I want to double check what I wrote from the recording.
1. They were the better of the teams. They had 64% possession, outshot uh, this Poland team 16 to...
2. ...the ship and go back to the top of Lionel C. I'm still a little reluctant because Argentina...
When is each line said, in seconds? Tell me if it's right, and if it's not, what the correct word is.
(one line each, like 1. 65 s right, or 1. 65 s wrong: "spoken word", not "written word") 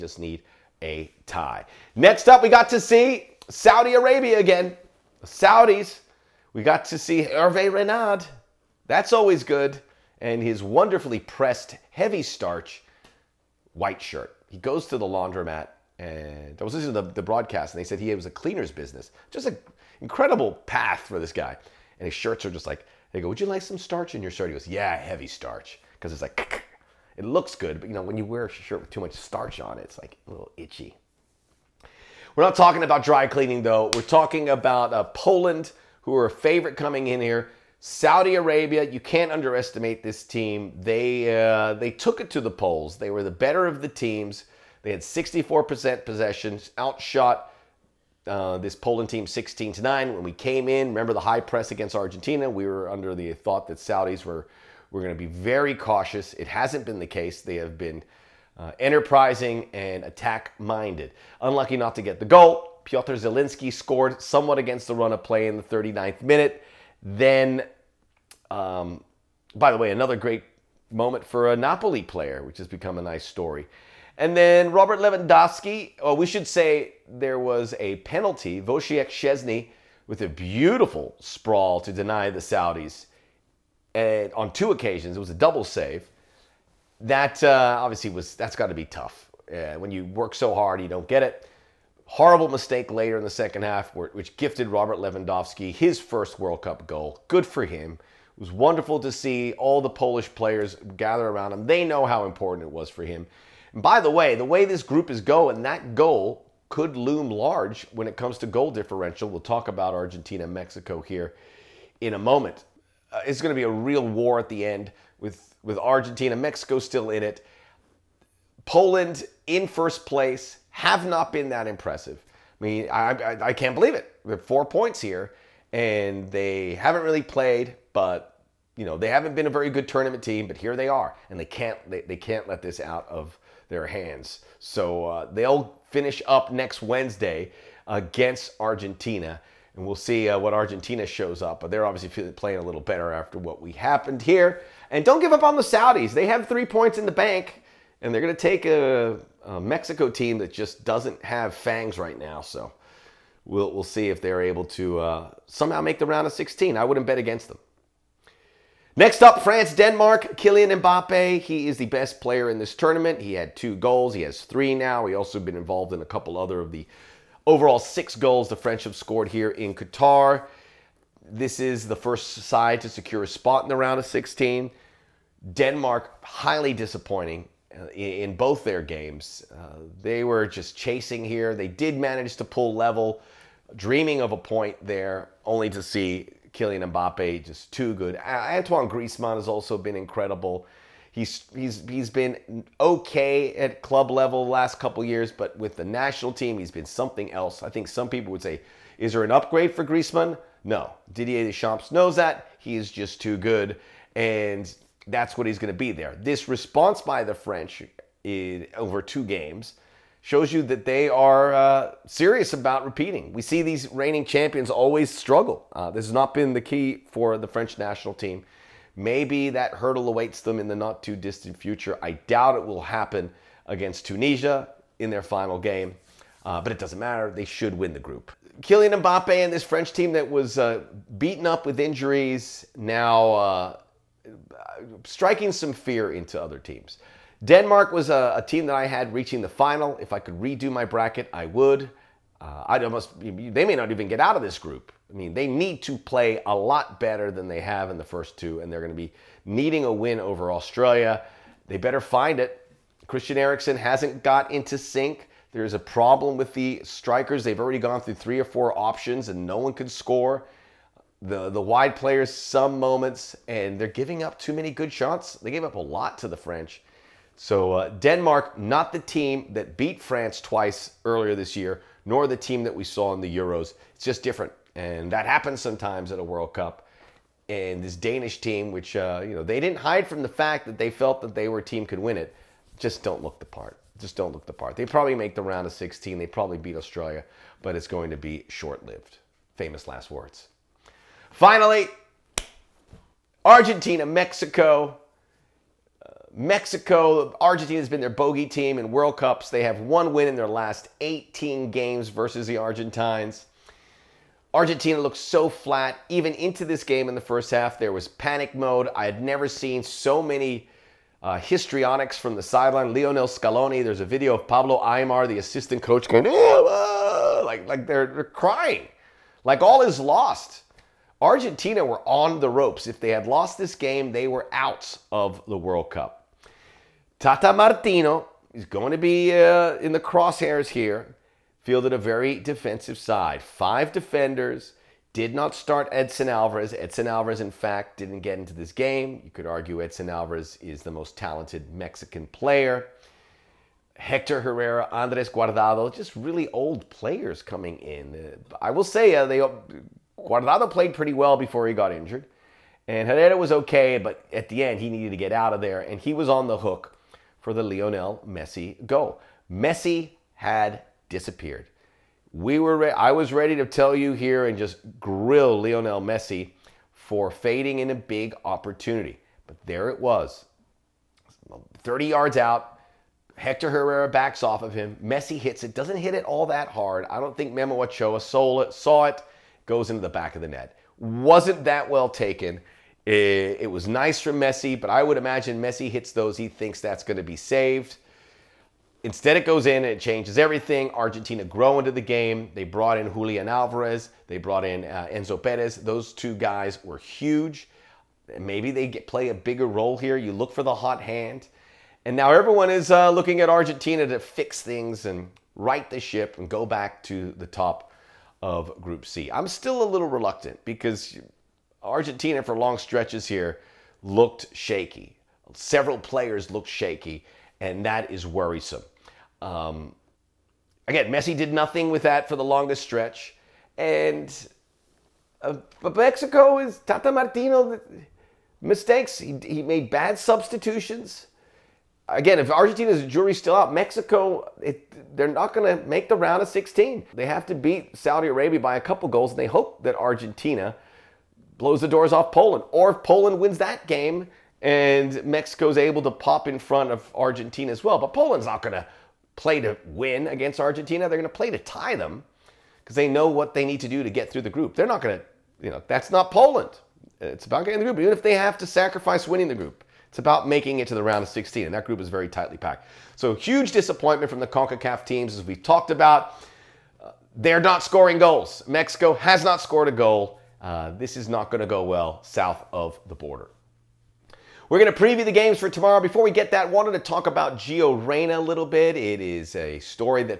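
1. 42 s right
2. 405 s wrong: "Group", not "Lionel".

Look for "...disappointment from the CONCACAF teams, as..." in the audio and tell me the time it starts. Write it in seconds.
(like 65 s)
463 s.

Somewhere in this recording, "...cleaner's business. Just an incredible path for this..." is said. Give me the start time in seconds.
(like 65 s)
18 s.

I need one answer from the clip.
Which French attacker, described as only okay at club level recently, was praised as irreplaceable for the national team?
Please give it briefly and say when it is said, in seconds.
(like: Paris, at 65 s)
Antoine Griezmann, at 188 s.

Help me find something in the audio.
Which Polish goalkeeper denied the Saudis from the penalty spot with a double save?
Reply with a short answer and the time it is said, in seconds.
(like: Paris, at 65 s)
Wojciech Szczesny, at 78 s.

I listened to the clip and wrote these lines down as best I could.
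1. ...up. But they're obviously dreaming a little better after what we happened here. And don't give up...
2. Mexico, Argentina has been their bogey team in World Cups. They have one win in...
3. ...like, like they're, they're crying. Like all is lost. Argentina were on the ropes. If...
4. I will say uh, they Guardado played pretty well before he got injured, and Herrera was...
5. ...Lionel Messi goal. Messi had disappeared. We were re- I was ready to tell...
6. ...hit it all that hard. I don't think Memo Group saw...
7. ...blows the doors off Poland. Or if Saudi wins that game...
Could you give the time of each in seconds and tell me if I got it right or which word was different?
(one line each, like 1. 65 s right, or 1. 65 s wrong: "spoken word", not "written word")
1. 141 s wrong: "playing", not "dreaming"
2. 296 s right
3. 317 s right
4. 348 s right
5. 357 s right
6. 375 s wrong: "Ochoa", not "Group"
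7. 441 s wrong: "Poland", not "Saudi".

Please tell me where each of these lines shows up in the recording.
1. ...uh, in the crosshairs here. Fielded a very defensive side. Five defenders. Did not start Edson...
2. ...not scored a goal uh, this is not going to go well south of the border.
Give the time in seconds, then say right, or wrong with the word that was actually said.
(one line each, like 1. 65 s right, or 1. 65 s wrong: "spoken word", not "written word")
1. 329 s right
2. 469 s right.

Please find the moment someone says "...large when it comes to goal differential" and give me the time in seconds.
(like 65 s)
107 s.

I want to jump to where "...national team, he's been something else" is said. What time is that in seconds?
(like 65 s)
195 s.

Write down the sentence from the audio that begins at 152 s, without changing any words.
So we'll, we'll see if they're able to uh, somehow make the round of 16.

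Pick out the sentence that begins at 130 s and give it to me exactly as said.
But here they are, and they can't they, they can't let this out of their hands.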